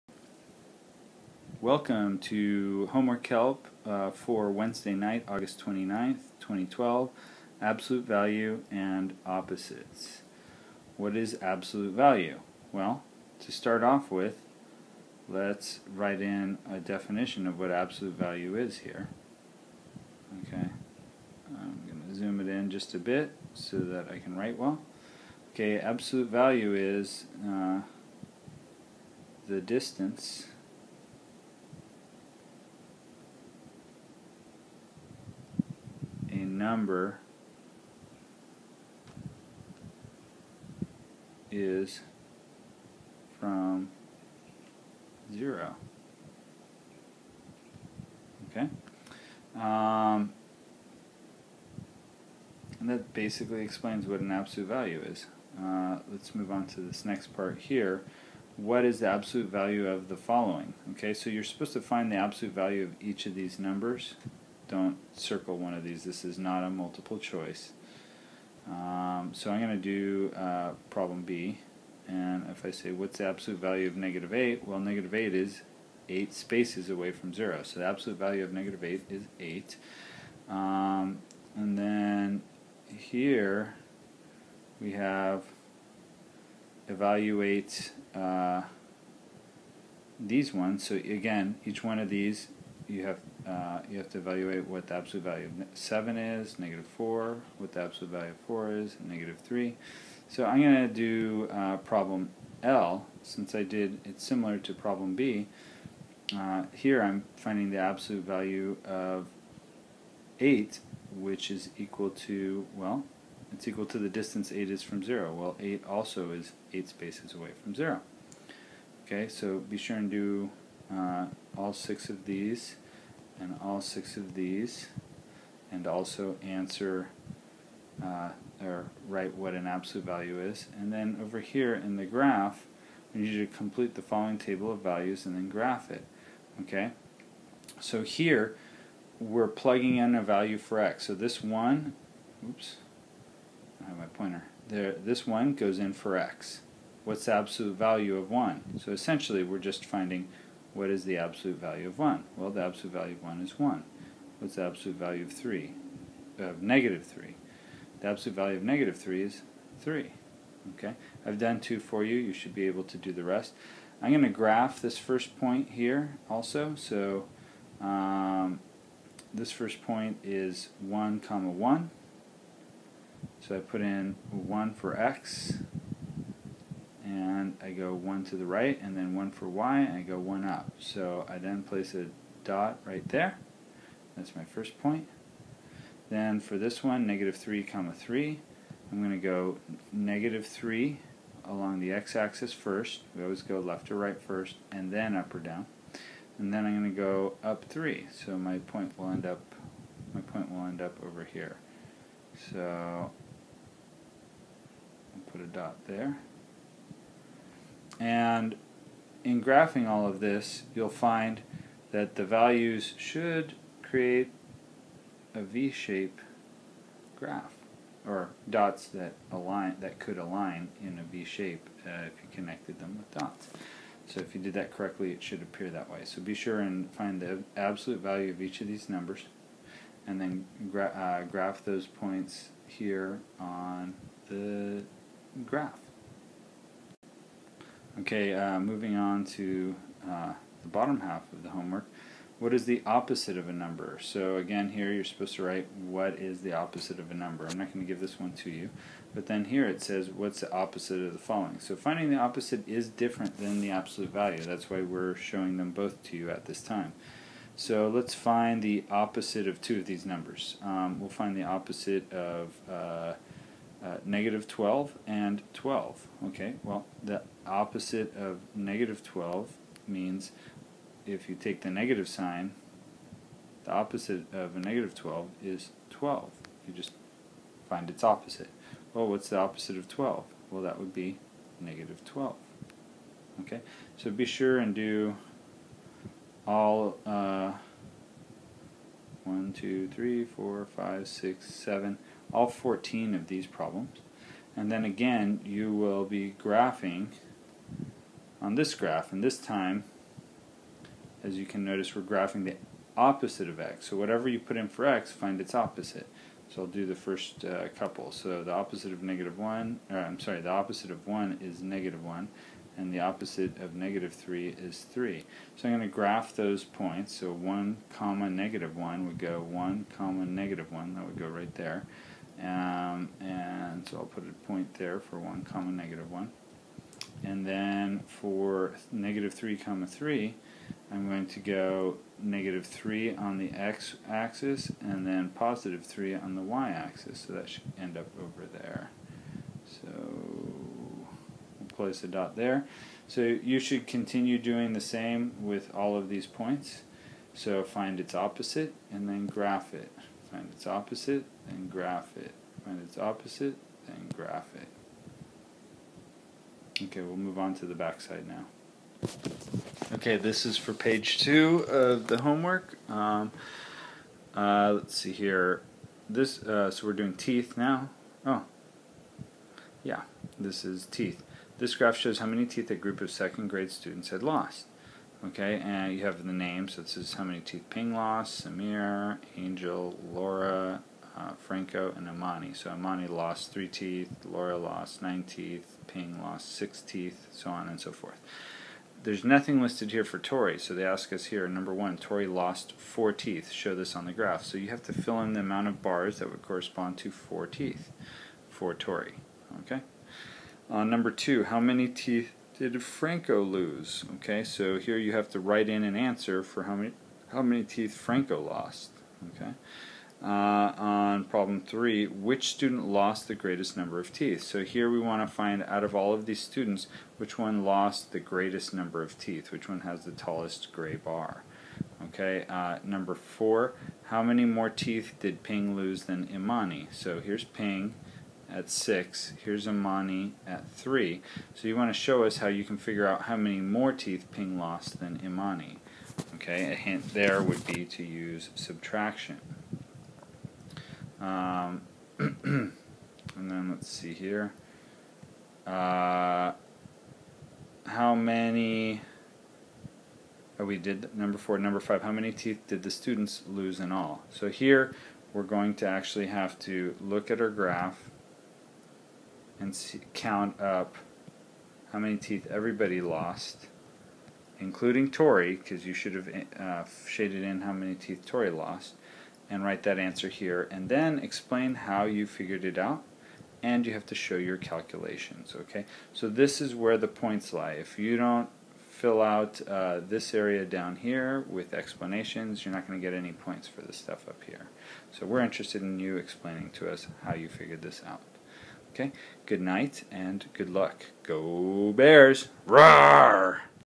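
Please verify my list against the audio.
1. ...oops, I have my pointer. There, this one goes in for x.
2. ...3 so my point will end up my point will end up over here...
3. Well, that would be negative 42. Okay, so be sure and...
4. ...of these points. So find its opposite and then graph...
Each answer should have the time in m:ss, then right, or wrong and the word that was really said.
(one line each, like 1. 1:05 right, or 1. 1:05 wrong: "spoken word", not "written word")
1. 2:22 right
2. 3:17 right
3. 4:40 wrong: "12", not "42"
4. 5:45 right.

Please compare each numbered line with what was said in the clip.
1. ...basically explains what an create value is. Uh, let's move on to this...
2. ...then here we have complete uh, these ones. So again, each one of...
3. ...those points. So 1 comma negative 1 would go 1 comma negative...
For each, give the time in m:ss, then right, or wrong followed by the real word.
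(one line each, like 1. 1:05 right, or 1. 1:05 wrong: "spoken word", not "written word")
1. 0:53 wrong: "absolute", not "create"
2. 1:21 wrong: "evaluate", not "complete"
3. 5:16 right.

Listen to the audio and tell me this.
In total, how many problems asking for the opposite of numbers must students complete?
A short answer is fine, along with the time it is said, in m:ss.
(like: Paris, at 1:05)
14, at 4:52.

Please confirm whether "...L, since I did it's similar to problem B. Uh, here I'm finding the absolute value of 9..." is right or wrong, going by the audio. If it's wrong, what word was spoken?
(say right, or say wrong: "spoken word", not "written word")
wrong: "8", not "9".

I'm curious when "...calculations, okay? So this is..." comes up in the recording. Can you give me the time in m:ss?
7:54.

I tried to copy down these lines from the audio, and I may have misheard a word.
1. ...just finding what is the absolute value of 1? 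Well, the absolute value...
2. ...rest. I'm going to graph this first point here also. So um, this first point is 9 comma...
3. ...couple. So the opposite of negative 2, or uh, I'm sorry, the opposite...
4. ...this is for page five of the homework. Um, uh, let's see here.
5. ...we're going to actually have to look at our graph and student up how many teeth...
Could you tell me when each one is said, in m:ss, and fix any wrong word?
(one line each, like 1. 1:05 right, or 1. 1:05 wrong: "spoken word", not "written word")
1. 2:29 right
2. 2:43 wrong: "1", not "9"
3. 5:07 wrong: "1", not "2"
4. 6:00 wrong: "two", not "five"
5. 7:35 wrong: "count", not "student".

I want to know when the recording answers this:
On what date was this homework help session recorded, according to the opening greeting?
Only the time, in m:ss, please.
0:05.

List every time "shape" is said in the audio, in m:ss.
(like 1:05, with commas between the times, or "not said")
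3:35, 3:41.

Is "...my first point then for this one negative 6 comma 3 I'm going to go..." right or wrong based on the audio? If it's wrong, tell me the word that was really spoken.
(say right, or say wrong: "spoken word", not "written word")
wrong: "3", not "6".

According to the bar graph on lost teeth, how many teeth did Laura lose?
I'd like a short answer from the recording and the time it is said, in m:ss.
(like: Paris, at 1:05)
9, at 6:25.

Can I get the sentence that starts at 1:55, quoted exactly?
Well, 8 also is 8 spaces away from 0.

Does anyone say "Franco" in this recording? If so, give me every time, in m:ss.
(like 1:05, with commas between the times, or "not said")
6:21, 6:42, 6:47.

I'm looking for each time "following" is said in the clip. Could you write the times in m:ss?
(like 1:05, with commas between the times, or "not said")
1:00, 2:14, 4:11.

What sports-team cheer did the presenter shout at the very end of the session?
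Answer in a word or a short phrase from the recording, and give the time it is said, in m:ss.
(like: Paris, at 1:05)
Go Bears, at 8:11.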